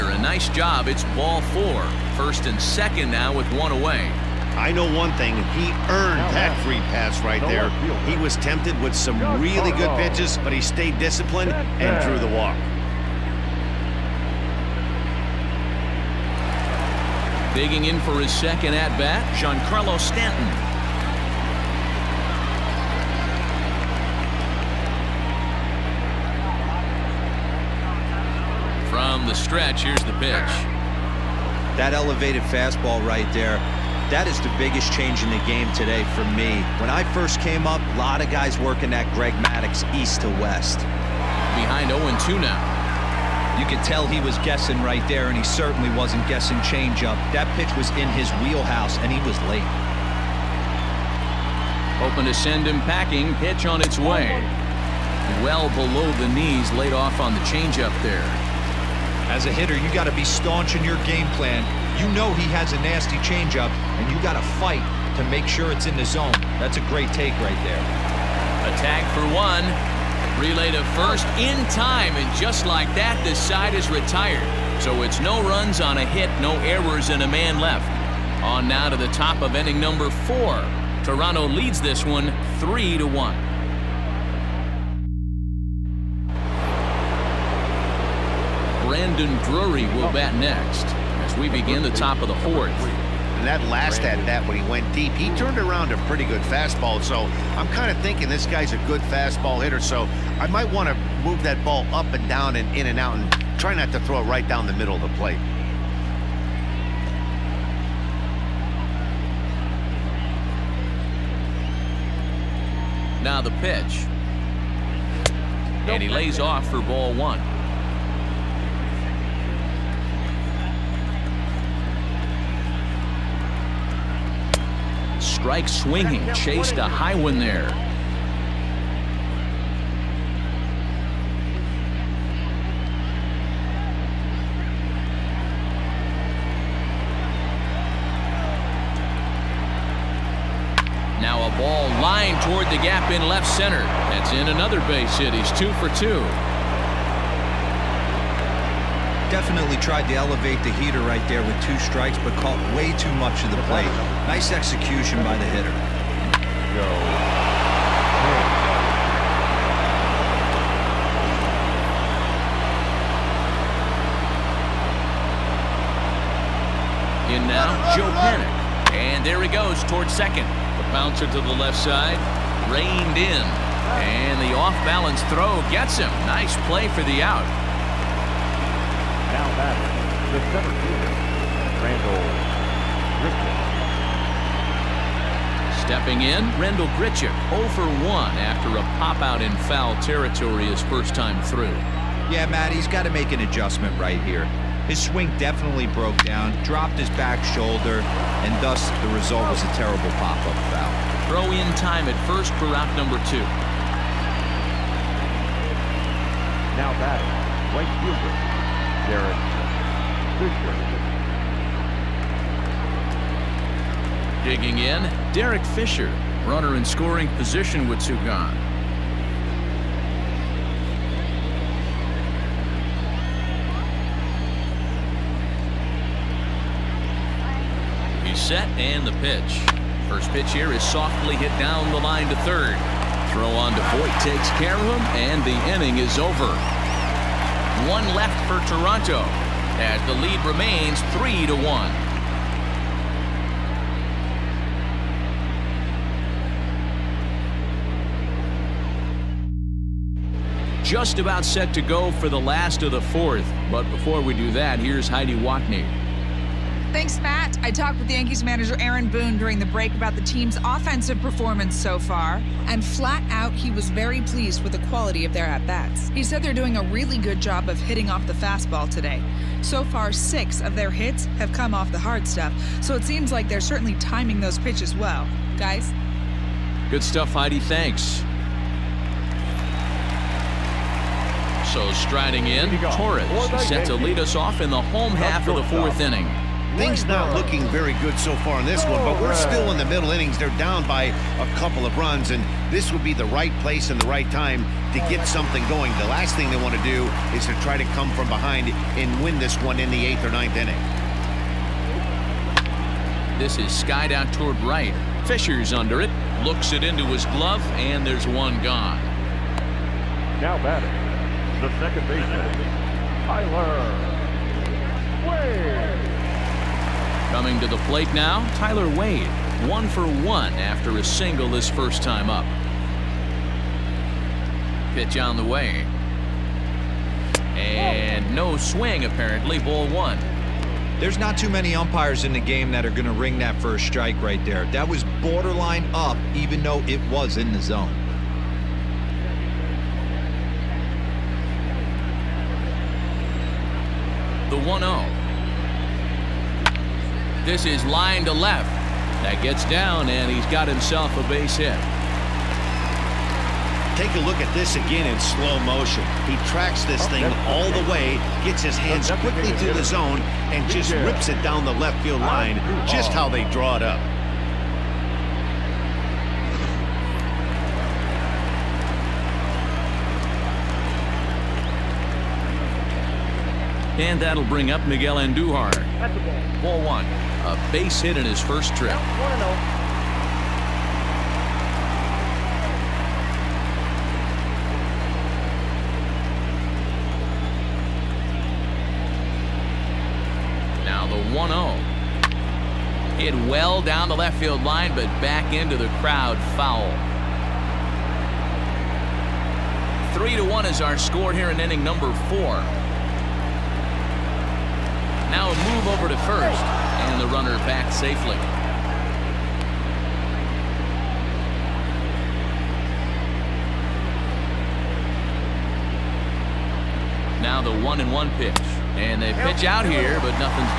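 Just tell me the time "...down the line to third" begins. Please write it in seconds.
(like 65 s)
231 s.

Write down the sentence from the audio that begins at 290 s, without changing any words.
They're down by a couple of runs, and this would be the right place and the right time to get something going.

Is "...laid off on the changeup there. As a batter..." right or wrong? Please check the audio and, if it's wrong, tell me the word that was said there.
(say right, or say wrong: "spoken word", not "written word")
wrong: "hitter", not "batter".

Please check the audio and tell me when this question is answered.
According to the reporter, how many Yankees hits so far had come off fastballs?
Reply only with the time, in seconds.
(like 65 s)
270 s.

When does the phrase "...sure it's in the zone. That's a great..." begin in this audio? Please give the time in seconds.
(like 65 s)
65 s.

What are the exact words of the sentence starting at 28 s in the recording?
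From the stretch, here's the pitch.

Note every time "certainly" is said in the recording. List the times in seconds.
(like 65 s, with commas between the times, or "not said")
45 s, 273 s.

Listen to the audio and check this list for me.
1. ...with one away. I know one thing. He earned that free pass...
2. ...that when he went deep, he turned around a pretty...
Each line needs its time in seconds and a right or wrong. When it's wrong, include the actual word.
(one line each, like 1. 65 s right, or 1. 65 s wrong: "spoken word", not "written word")
1. 3 s right
2. 94 s right.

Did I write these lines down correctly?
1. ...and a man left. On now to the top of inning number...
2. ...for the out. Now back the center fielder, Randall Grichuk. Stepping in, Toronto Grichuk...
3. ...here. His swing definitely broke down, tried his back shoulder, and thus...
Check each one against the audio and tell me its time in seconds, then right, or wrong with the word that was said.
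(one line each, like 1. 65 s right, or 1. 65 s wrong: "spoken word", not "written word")
1. 77 s right
2. 176 s wrong: "Randall", not "Toronto"
3. 194 s wrong: "dropped", not "tried".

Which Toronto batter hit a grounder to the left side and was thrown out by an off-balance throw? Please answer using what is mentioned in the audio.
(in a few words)
Joe Panik.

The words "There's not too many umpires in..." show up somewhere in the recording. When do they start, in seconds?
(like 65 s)
330 s.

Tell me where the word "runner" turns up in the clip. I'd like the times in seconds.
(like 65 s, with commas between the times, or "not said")
216 s, 407 s.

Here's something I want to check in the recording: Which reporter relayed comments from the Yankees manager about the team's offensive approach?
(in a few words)
Heidi Watney.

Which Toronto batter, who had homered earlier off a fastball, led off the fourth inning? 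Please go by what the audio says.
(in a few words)
Brandon Drury.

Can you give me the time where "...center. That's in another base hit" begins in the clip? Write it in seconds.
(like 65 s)
143 s.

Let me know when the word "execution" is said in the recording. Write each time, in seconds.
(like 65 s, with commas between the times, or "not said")
154 s.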